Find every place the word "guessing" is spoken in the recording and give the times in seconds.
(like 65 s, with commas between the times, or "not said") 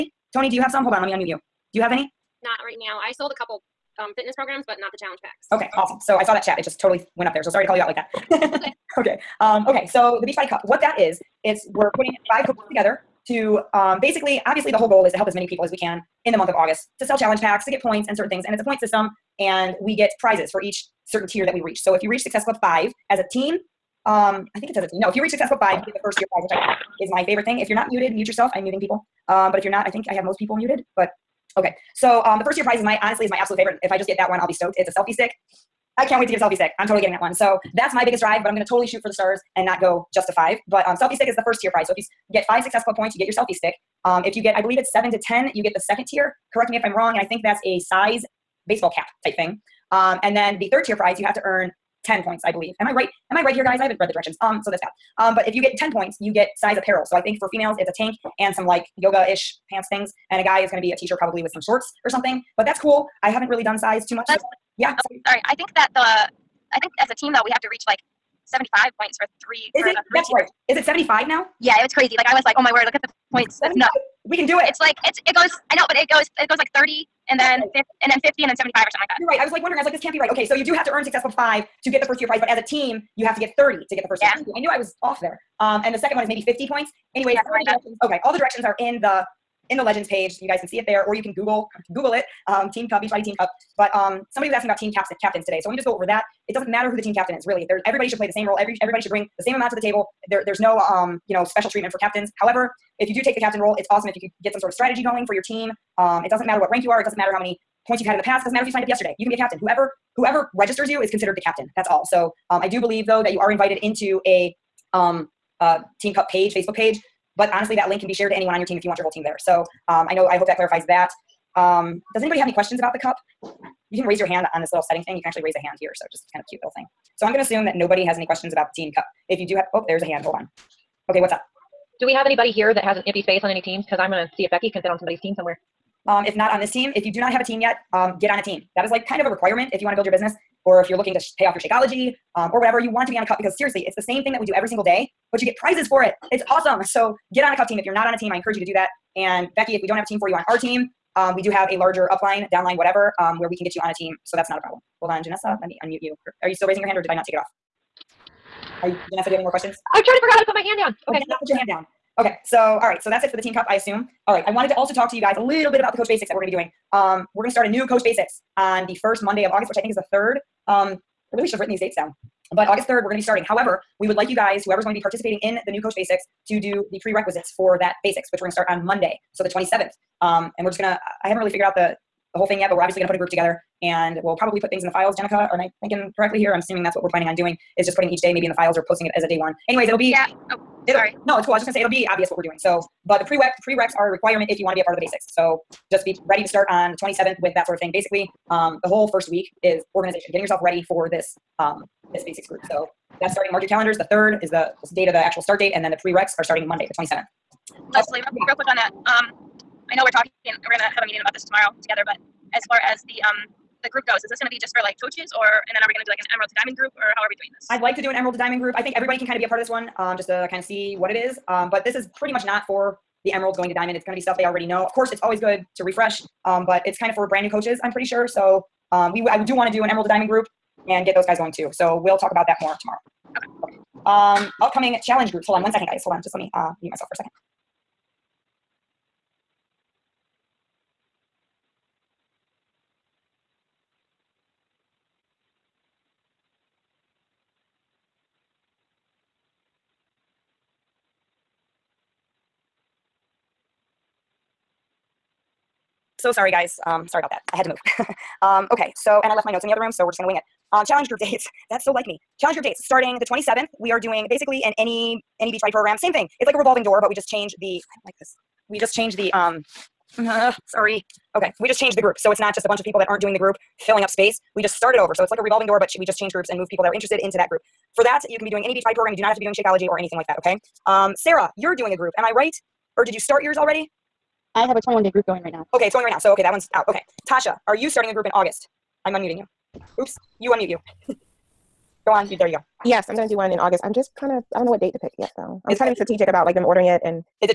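not said.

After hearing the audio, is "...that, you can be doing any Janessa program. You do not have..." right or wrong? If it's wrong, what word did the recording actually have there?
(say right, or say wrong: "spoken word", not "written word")
wrong: "Beachbody", not "Janessa".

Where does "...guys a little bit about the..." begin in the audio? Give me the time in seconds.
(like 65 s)
165 s.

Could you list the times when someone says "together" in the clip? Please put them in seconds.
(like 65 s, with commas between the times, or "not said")
12 s, 183 s, 211 s.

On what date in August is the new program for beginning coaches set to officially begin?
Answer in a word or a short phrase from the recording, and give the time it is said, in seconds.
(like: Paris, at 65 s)
August 3rd, at 172 s.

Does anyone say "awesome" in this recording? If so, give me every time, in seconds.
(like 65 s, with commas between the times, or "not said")
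5 s, 103 s, 146 s.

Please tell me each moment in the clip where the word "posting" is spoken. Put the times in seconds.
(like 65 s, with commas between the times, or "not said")
188 s.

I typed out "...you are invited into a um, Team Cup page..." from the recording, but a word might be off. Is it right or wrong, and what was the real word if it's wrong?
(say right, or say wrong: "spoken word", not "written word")
right.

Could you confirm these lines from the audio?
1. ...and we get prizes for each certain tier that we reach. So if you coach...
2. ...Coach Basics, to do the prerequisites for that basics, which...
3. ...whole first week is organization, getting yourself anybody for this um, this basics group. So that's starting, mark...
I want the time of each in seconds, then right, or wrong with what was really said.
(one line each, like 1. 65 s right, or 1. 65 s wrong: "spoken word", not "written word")
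1. 19 s wrong: "reach", not "coach"
2. 175 s right
3. 198 s wrong: "ready", not "anybody".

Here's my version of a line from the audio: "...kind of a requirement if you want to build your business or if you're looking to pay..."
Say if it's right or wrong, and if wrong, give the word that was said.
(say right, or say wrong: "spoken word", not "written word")
right.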